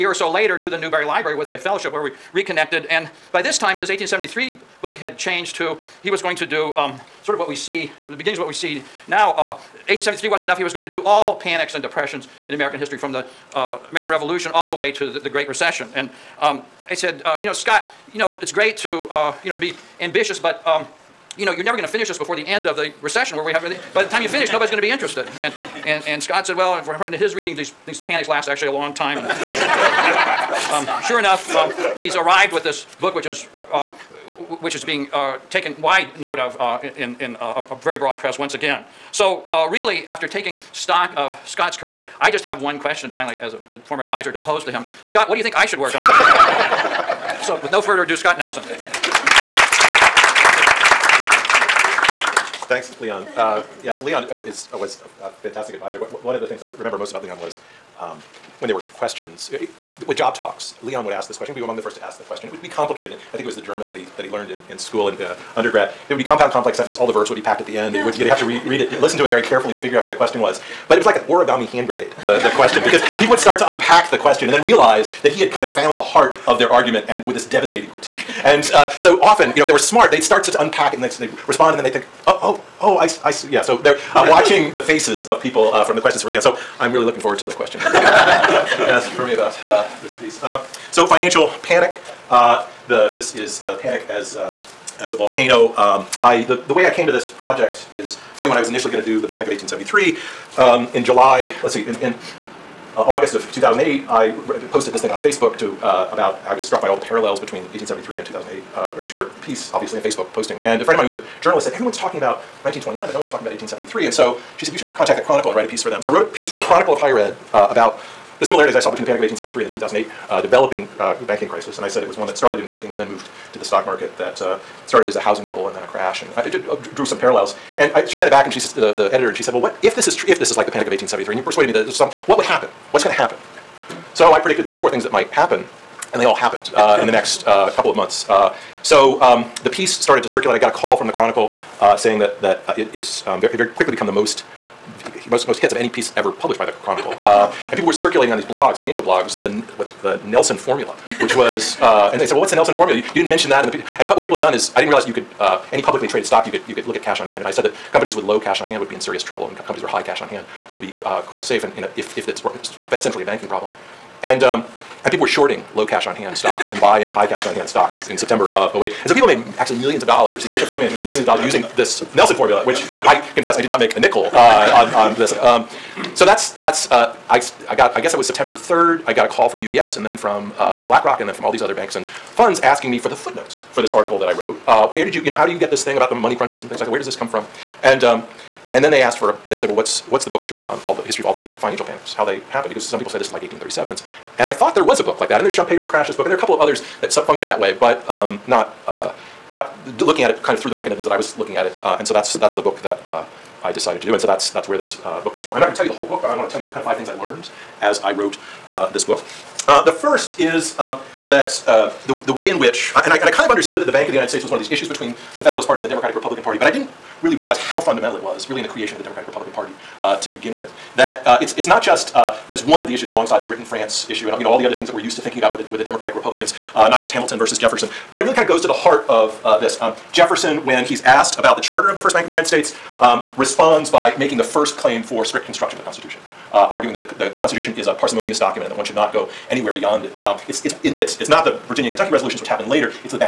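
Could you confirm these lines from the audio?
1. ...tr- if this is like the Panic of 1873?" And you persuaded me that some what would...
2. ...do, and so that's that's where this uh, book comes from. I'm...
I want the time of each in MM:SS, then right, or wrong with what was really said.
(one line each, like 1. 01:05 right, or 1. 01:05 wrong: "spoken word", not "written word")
1. 02:10 right
2. 03:24 right.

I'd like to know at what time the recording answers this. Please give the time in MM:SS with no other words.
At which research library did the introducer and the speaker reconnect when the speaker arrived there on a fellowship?
00:00.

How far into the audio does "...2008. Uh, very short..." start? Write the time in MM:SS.
01:48.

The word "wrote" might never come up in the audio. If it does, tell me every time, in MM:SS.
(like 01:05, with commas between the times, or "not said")
01:56, 03:04, 03:28.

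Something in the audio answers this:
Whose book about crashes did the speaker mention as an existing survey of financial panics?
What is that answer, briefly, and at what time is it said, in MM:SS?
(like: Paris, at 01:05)
Schumpeter, at 03:15.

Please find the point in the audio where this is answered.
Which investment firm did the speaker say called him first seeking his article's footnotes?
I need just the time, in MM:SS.
02:59.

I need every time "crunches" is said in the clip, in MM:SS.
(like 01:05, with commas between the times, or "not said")
03:06.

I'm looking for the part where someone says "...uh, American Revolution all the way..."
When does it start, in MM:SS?
00:13.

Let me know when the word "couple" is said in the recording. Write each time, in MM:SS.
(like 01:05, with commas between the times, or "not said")
02:17, 03:16.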